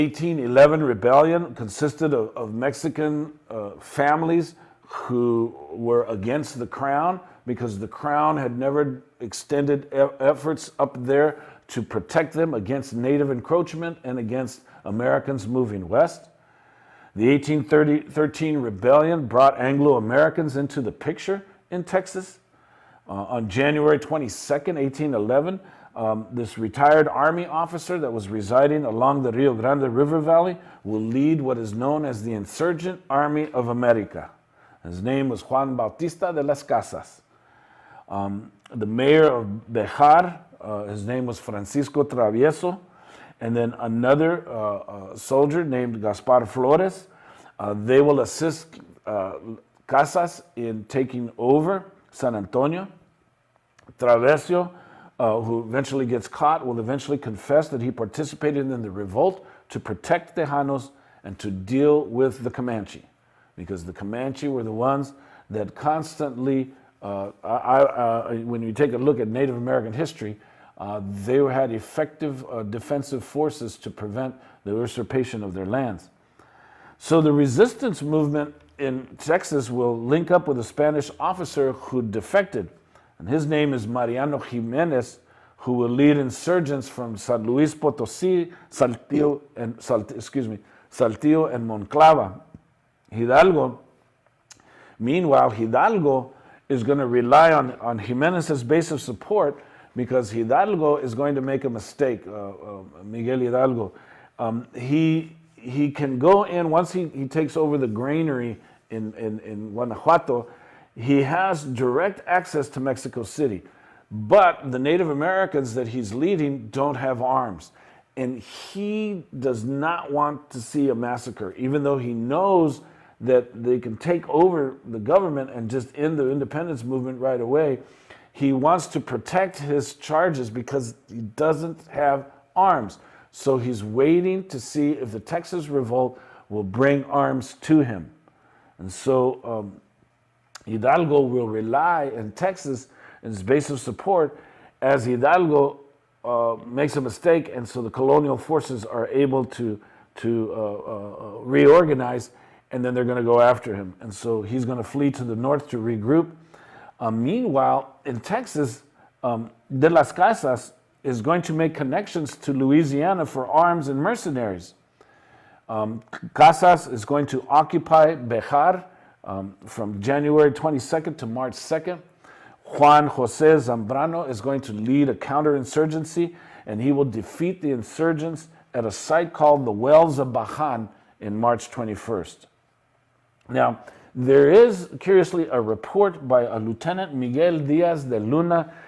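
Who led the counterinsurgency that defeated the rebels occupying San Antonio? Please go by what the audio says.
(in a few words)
Juan Jose Zambrano.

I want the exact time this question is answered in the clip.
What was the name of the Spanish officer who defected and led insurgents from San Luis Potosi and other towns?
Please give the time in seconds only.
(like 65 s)
83 s.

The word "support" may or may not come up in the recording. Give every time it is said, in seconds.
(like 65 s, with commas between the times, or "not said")
99 s, 143 s.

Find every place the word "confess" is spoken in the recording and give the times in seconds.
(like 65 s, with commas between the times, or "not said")
57 s.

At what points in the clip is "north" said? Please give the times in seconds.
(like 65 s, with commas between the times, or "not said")
155 s.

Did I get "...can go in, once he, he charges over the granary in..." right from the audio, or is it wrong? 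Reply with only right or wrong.
wrong.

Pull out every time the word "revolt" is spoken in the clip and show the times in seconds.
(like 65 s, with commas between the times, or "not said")
58 s, 135 s.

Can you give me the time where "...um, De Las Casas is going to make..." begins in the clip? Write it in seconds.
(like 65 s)
159 s.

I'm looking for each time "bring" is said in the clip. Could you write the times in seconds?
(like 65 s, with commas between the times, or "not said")
136 s.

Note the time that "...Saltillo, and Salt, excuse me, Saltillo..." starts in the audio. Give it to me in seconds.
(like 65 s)
88 s.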